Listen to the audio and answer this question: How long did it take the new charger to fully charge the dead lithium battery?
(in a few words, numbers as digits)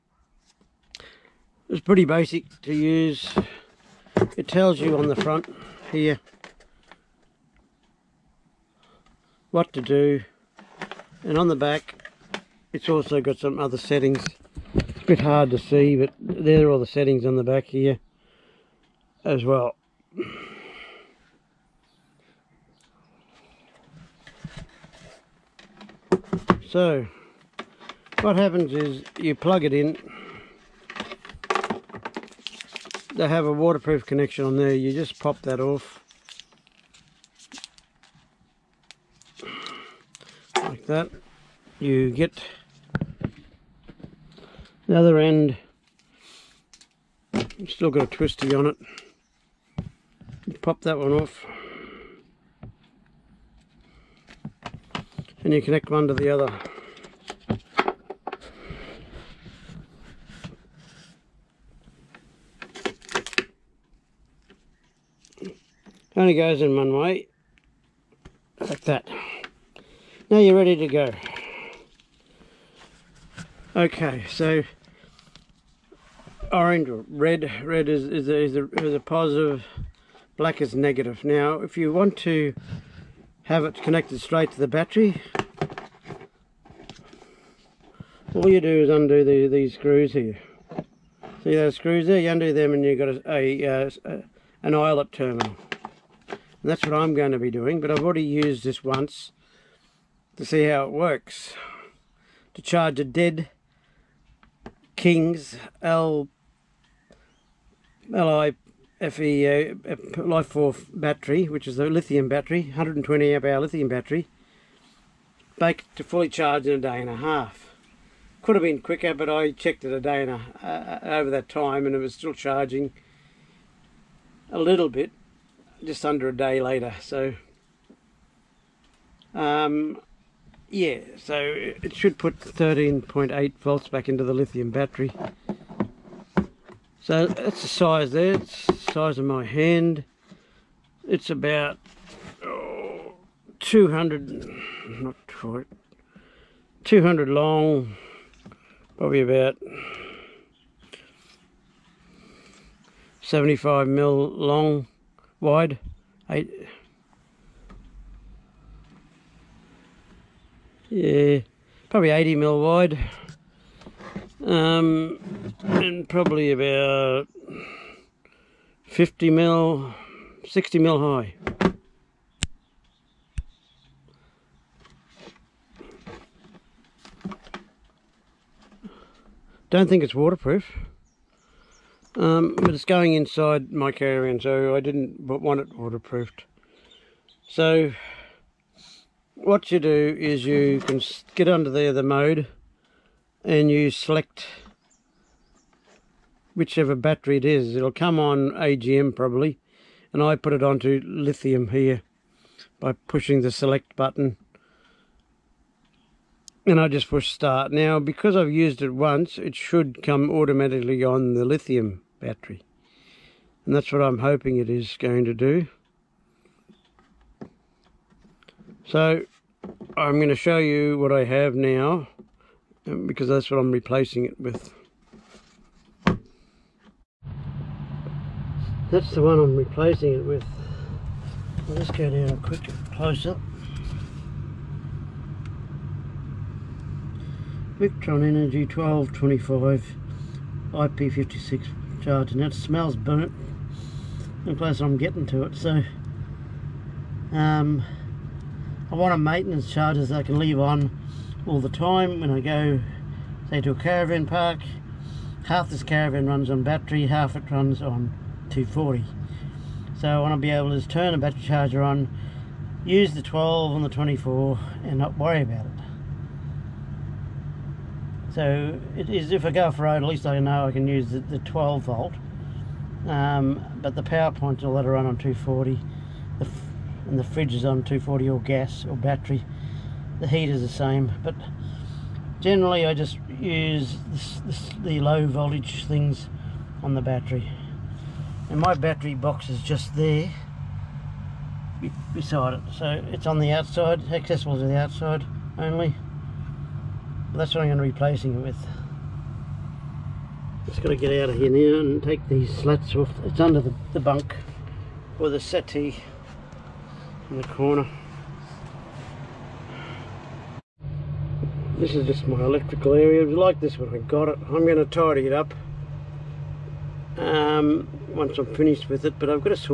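a day and a half.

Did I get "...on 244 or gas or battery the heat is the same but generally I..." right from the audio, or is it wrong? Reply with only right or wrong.
wrong.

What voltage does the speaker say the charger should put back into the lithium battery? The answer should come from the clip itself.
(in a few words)
13.8 volts.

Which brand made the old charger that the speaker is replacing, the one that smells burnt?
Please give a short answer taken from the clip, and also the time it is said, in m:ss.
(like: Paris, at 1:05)
Victron Energy, at 3:57.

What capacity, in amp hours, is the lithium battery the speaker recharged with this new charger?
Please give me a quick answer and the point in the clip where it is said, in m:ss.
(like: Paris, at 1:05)
120 amp hour, at 1:52.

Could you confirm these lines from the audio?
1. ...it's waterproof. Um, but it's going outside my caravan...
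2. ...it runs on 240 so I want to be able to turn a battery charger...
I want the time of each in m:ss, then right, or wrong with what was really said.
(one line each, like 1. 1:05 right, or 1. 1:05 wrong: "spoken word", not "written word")
1. 3:00 wrong: "inside", not "outside"
2. 4:17 right.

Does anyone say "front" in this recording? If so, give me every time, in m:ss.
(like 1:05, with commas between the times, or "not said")
0:05.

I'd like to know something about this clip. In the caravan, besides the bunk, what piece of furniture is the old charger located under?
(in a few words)
settee.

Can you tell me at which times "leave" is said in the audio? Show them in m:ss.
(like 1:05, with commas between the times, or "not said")
4:10.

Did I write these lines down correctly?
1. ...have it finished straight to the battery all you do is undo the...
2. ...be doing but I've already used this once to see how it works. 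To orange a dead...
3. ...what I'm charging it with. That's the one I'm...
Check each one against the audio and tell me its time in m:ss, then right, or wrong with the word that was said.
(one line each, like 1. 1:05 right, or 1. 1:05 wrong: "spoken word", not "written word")
1. 1:23 wrong: "connected", not "finished"
2. 1:37 wrong: "charge", not "orange"
3. 3:43 wrong: "replacing", not "charging".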